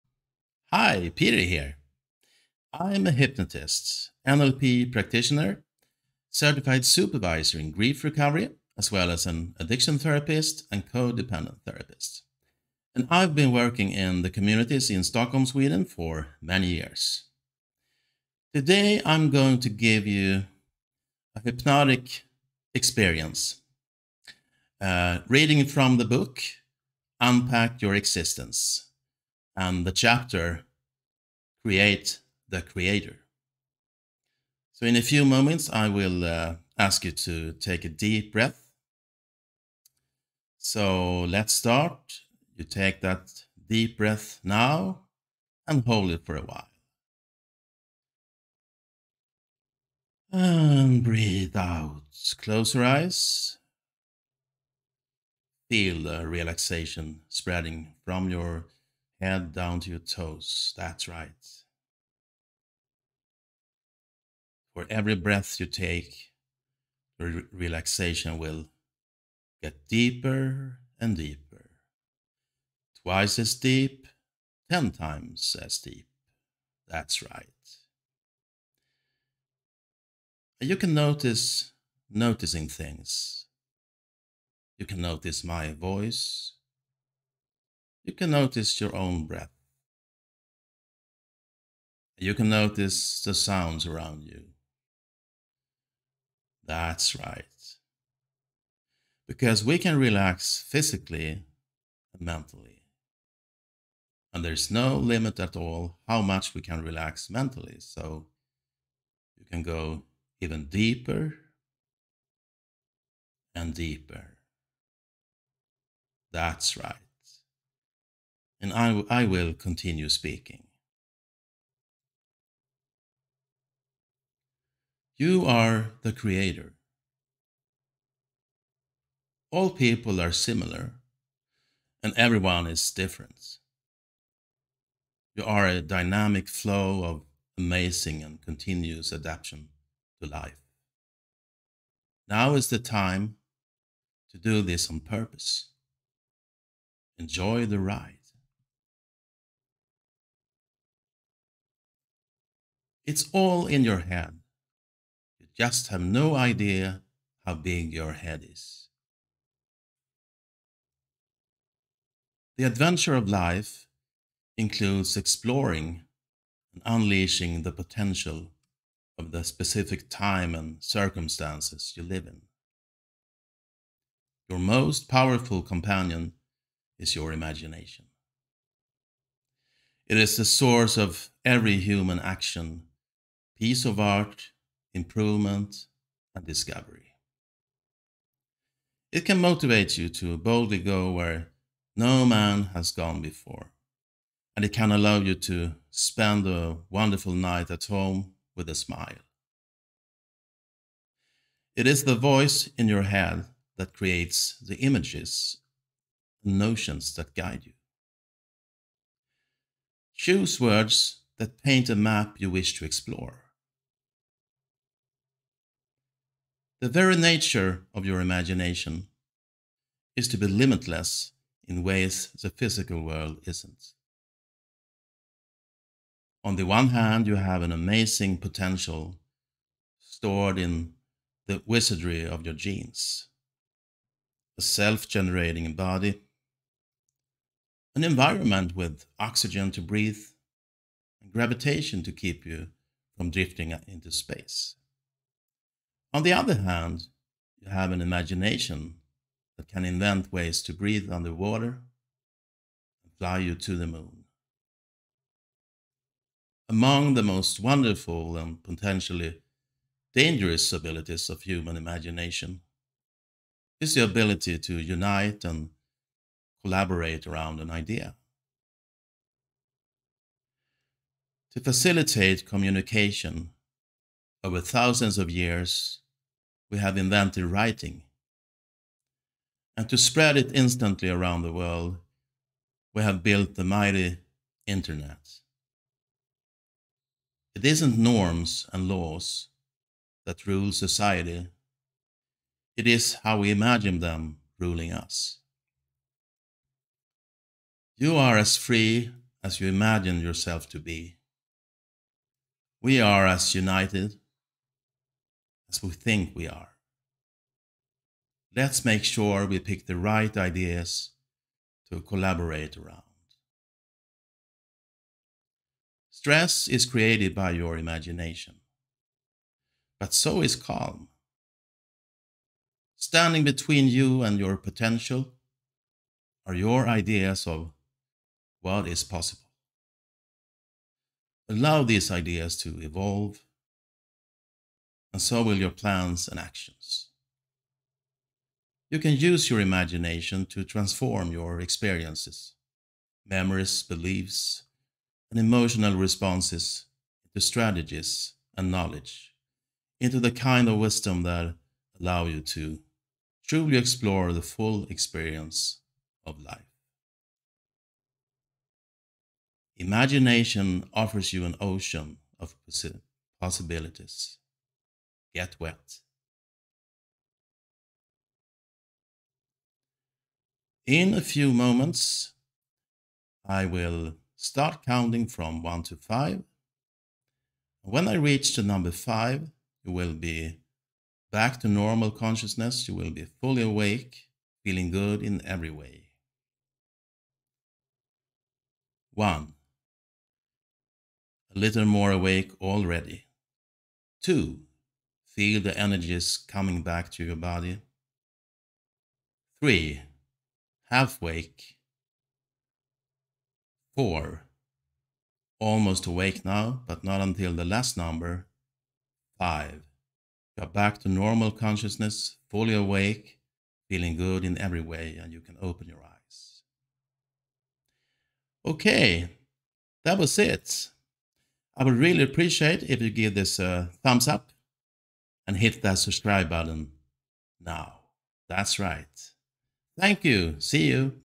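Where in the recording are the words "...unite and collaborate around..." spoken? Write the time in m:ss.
4:24.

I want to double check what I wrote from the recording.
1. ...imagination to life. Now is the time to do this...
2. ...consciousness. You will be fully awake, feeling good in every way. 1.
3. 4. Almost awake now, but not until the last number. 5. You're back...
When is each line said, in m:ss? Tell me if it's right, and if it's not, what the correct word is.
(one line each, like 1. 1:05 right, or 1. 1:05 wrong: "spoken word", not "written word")
1. 2:19 wrong: "adaptation", not "imagination"
2. 6:22 right
3. 6:43 right.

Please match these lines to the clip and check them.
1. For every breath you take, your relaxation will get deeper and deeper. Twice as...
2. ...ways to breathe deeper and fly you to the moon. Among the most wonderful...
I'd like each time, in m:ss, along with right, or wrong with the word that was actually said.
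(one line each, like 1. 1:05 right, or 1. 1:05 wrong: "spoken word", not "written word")
1. 1:04 right
2. 4:10 wrong: "underwater", not "deeper".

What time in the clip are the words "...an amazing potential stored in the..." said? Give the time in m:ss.
3:47.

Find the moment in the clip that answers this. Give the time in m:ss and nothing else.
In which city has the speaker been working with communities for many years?
0:15.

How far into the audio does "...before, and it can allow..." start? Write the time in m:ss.
3:13.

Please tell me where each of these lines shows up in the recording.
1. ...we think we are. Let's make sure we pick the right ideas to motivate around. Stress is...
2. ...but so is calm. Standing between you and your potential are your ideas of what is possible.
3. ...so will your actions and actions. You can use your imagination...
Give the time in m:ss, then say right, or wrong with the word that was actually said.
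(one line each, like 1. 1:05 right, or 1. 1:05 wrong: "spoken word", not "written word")
1. 5:05 wrong: "collaborate", not "motivate"
2. 5:19 right
3. 5:35 wrong: "plans", not "actions".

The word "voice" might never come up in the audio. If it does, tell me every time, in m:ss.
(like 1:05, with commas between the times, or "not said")
1:25, 3:22.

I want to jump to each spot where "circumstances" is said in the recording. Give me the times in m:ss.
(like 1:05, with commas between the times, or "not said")
2:50.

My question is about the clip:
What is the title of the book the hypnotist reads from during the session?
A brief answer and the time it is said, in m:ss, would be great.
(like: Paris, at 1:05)
Unpack Your Existence, at 0:27.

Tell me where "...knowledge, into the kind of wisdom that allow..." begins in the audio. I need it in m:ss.
5:48.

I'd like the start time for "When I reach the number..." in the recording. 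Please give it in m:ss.
6:17.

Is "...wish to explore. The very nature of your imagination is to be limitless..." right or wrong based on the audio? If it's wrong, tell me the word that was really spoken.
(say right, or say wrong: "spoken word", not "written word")
right.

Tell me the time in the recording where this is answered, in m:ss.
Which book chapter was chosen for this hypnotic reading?
0:31.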